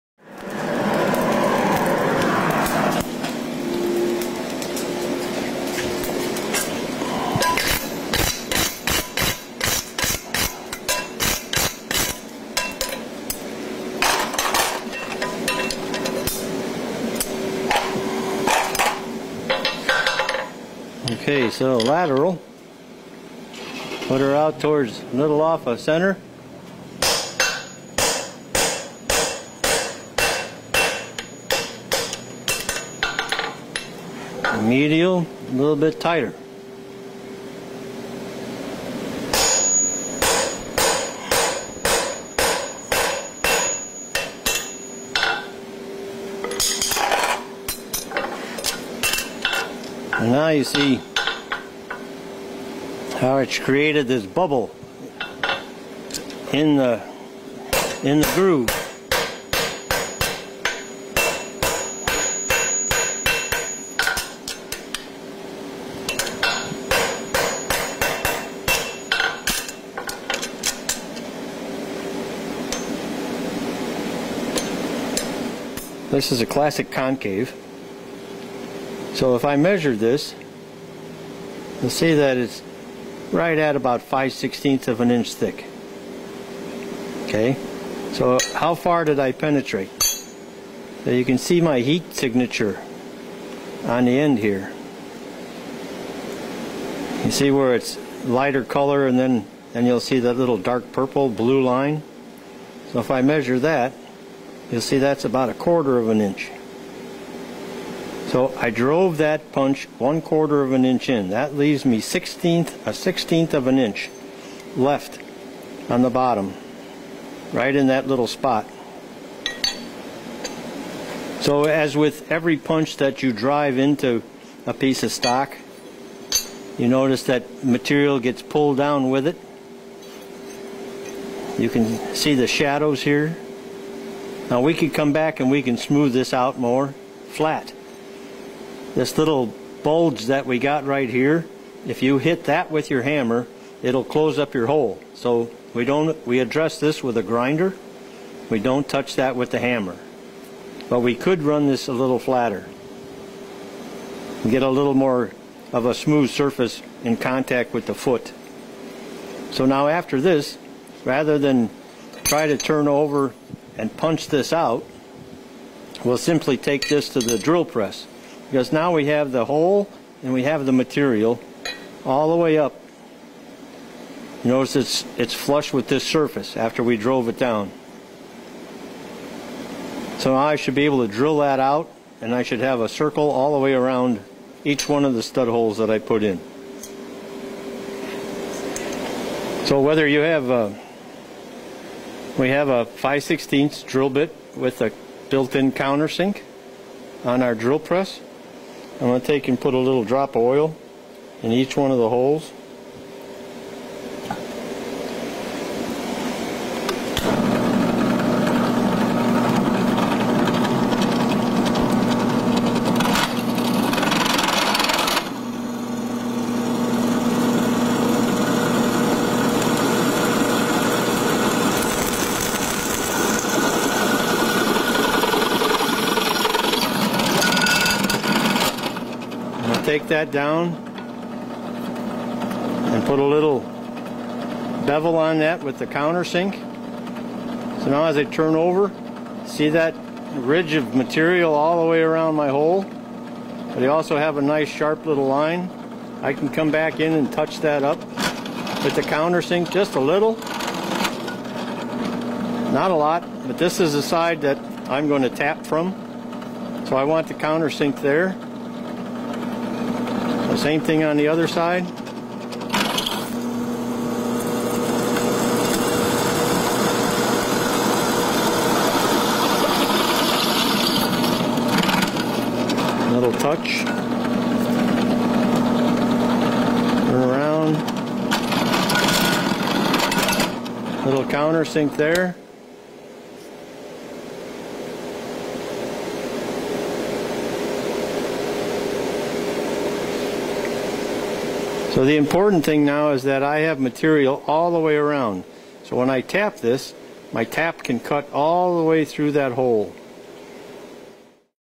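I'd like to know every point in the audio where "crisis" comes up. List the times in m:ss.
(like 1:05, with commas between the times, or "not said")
not said.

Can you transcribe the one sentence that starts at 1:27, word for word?
Okay, so how far did I penetrate?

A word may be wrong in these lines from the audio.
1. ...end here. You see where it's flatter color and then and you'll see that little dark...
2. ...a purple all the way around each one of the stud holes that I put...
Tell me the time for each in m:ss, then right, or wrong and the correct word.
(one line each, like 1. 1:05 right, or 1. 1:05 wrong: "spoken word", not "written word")
1. 1:34 wrong: "lighter", not "flatter"
2. 3:02 wrong: "circle", not "purple".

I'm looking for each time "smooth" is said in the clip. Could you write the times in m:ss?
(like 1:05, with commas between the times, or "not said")
2:15, 2:35.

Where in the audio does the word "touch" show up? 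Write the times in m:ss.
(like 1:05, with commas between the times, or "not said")
2:28, 4:07, 4:33.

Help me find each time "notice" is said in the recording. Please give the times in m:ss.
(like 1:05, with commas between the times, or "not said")
2:06, 2:54.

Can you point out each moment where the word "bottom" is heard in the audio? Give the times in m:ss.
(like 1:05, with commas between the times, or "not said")
1:56.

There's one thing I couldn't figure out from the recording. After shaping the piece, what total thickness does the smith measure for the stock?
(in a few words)
5/16 inch.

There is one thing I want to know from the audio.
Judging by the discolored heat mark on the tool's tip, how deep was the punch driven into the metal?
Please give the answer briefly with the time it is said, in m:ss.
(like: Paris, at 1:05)
a quarter of an inch, at 1:45.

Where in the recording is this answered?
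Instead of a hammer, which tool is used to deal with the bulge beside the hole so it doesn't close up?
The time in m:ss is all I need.
2:27.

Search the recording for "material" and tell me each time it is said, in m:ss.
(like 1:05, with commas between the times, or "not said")
2:07, 2:50, 4:00, 4:53.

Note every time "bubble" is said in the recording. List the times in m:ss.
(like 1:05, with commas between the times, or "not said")
0:54.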